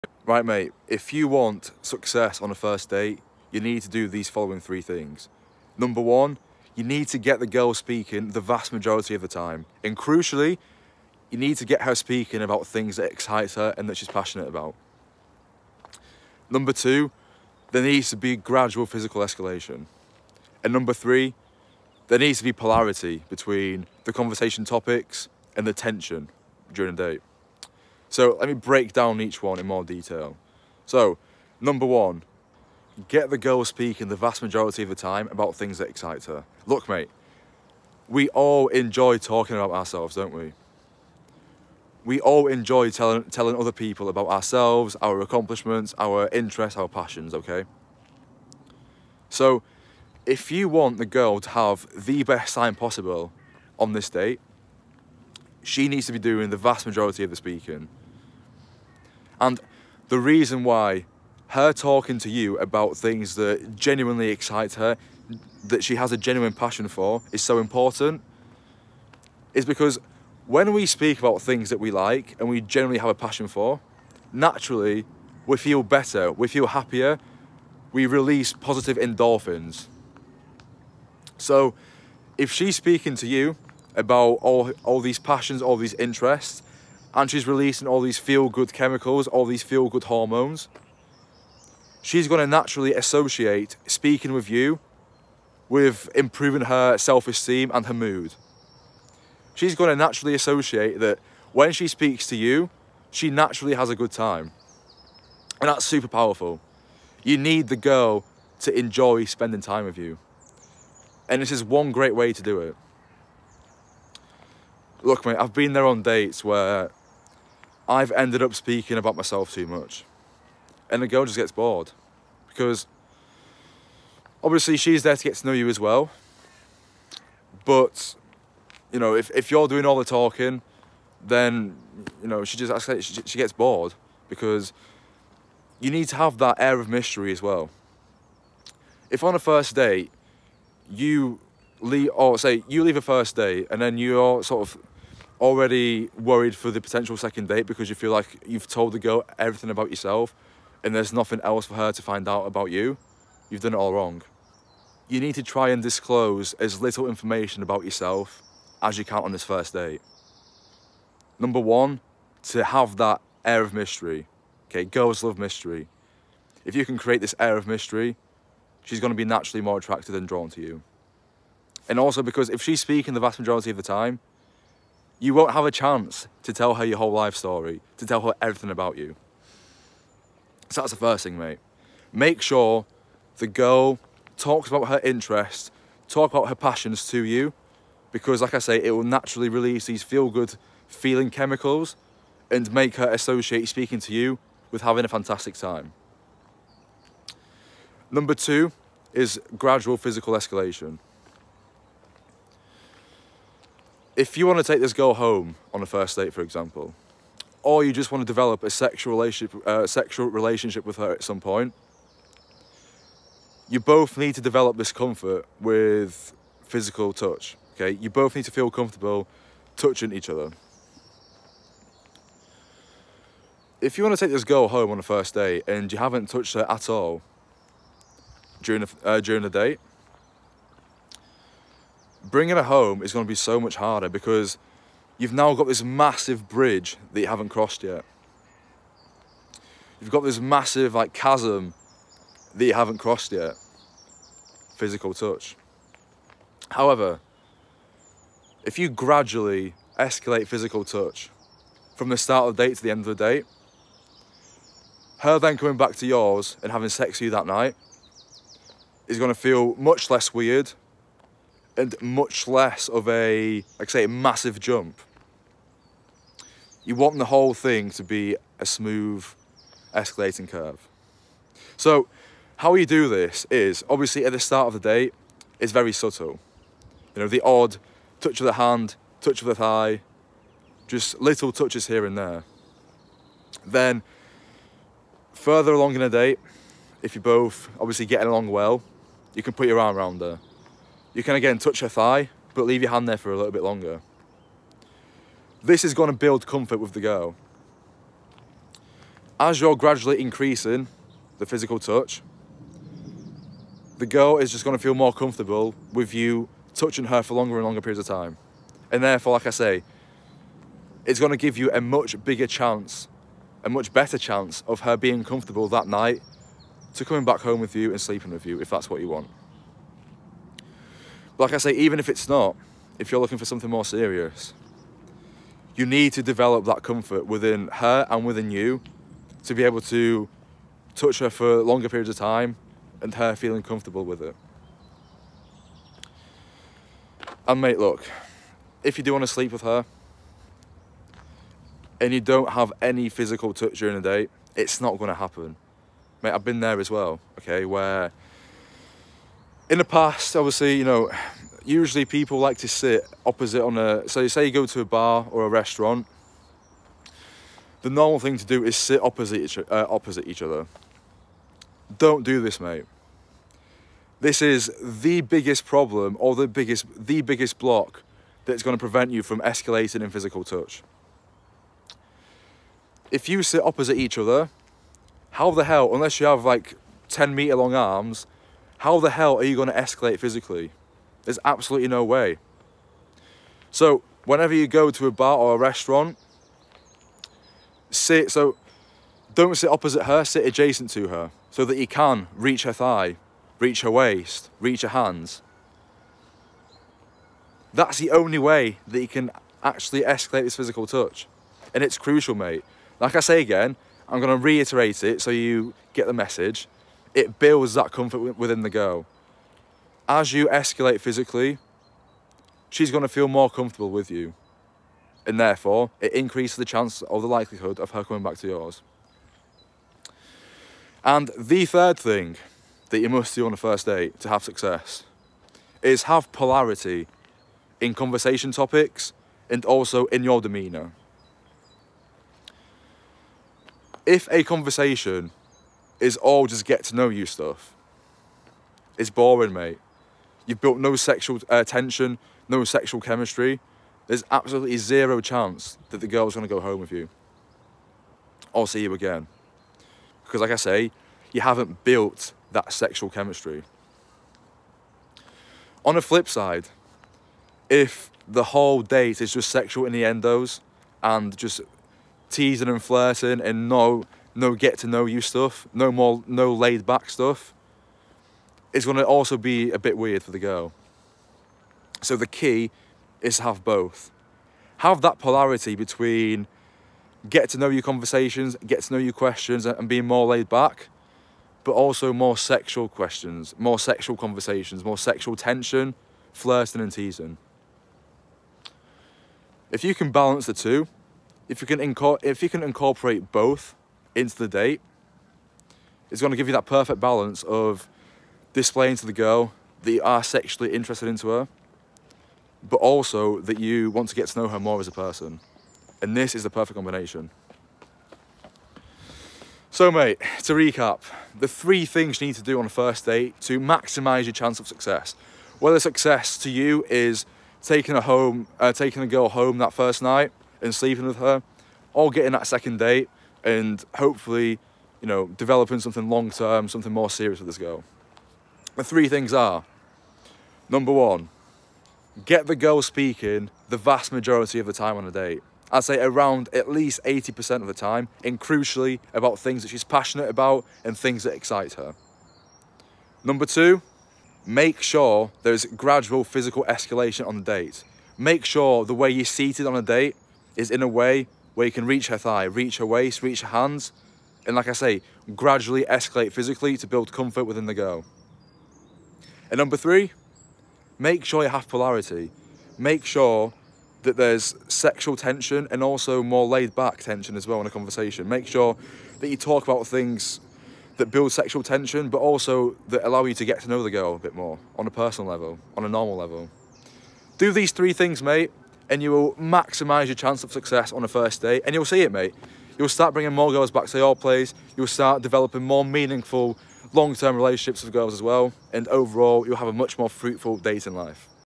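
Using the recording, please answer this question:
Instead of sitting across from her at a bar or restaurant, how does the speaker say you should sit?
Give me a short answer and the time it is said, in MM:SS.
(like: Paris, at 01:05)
adjacent, at 06:30.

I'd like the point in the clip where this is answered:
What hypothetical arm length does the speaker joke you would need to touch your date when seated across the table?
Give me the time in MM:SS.
06:17.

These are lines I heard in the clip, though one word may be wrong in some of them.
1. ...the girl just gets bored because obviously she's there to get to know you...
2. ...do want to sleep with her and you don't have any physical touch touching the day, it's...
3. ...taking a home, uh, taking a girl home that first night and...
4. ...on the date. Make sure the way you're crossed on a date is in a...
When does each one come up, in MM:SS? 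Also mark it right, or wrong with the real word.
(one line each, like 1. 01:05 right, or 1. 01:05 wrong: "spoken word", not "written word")
1. 02:01 right
2. 05:39 wrong: "during", not "touching"
3. 08:37 right
4. 09:07 wrong: "seated", not "crossed".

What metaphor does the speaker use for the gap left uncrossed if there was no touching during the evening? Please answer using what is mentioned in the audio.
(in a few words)
chasm.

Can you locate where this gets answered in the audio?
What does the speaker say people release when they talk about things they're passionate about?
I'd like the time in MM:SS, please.
01:18.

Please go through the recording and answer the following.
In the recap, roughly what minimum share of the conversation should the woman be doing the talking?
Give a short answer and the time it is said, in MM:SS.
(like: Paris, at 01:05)
80%, at 08:56.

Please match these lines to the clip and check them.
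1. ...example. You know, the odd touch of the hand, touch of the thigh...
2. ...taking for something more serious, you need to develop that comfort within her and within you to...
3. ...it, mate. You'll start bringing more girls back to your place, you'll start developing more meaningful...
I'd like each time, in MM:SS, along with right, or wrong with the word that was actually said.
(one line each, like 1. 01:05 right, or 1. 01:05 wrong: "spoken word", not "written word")
1. 04:35 wrong: "subtle", not "example"
2. 05:23 wrong: "looking", not "taking"
3. 09:42 right.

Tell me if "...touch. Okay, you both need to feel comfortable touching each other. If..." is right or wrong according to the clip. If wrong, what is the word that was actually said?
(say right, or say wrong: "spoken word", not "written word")
right.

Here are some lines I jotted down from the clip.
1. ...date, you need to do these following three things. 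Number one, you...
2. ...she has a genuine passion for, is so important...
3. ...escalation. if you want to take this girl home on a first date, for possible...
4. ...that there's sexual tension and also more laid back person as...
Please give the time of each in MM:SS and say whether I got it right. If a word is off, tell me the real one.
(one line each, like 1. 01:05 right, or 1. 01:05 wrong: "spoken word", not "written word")
1. 00:02 right
2. 01:05 right
3. 03:20 wrong: "example", not "possible"
4. 09:24 wrong: "tension", not "person".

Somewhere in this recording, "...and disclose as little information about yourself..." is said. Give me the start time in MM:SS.
02:35.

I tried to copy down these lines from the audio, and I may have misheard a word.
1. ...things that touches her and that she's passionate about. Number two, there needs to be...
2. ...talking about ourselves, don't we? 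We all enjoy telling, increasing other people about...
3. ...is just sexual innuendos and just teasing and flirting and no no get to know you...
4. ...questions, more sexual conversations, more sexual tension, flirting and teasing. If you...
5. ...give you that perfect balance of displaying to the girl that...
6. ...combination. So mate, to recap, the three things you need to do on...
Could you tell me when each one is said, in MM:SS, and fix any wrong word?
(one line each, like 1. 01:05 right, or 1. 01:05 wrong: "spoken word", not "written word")
1. 00:12 wrong: "excites", not "touches"
2. 00:39 wrong: "telling", not "increasing"
3. 07:39 right
4. 08:02 right
5. 08:16 right
6. 08:26 right.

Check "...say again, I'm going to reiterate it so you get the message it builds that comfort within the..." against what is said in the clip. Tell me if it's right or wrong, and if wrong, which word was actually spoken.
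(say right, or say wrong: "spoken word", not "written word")
right.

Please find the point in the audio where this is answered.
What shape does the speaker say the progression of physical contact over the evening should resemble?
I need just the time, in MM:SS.
04:28.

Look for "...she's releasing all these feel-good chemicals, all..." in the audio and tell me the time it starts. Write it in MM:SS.
01:27.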